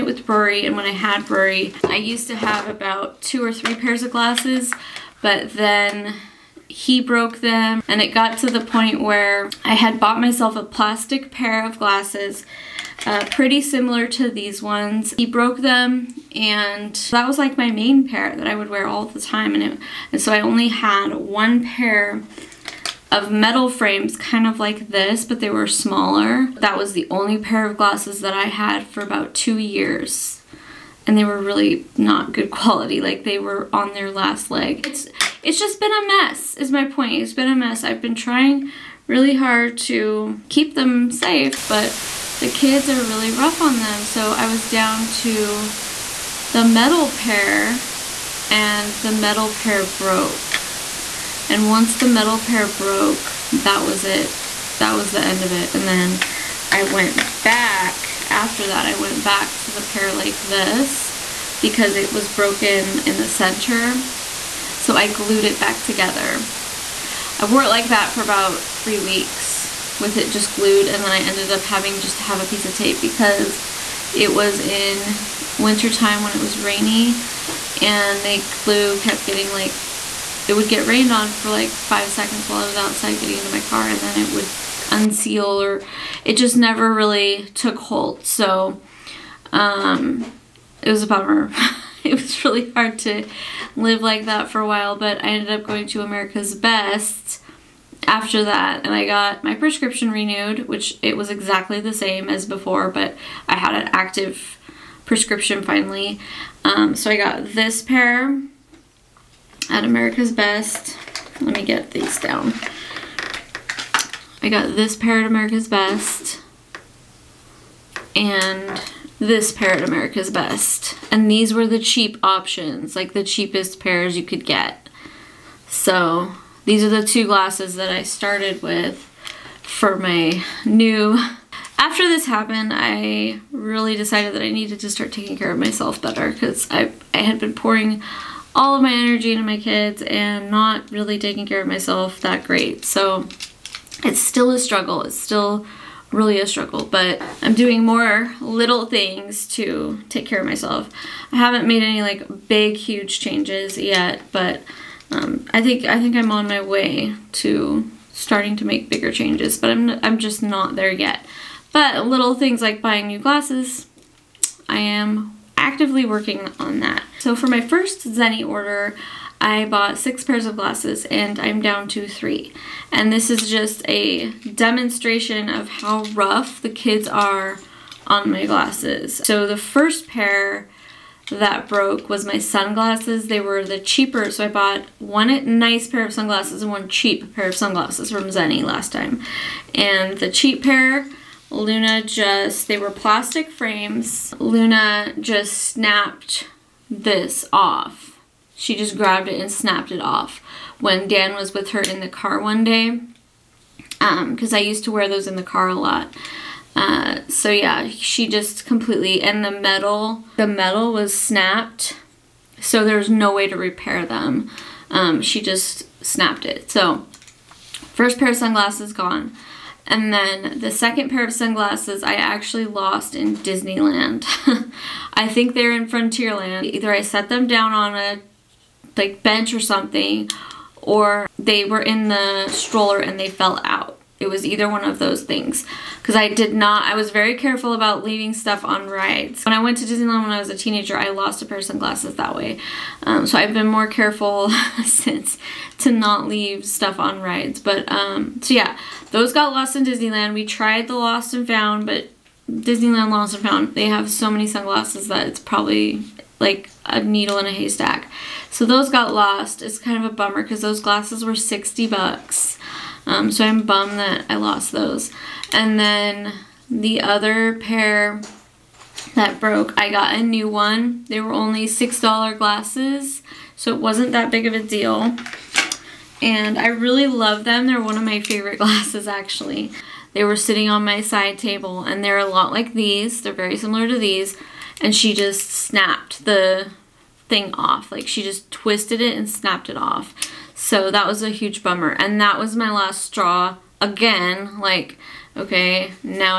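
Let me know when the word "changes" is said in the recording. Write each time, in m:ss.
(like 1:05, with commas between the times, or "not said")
2:33, 2:39.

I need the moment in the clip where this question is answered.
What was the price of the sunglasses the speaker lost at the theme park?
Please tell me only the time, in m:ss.
4:21.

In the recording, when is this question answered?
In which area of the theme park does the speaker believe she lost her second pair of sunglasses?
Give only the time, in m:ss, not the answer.
3:45.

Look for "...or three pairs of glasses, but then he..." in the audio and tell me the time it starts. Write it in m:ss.
0:03.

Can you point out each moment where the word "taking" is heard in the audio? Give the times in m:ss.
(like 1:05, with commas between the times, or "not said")
2:15, 2:21.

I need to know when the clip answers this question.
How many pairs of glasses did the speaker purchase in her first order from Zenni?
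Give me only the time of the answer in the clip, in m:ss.
2:49.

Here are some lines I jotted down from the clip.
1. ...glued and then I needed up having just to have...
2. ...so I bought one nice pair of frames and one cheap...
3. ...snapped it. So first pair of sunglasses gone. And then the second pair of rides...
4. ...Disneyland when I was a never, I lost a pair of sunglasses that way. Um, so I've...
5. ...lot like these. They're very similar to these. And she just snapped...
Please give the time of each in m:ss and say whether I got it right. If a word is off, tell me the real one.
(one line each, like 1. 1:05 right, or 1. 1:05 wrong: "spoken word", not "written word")
1. 1:10 wrong: "ended", not "needed"
2. 3:04 wrong: "sunglasses", not "frames"
3. 3:36 wrong: "sunglasses", not "rides"
4. 3:59 wrong: "teenager", not "never"
5. 4:42 right.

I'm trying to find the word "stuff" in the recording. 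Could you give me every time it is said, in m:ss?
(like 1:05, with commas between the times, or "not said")
3:58, 4:06.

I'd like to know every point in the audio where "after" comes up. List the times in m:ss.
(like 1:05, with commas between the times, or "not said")
0:58, 1:38, 2:11.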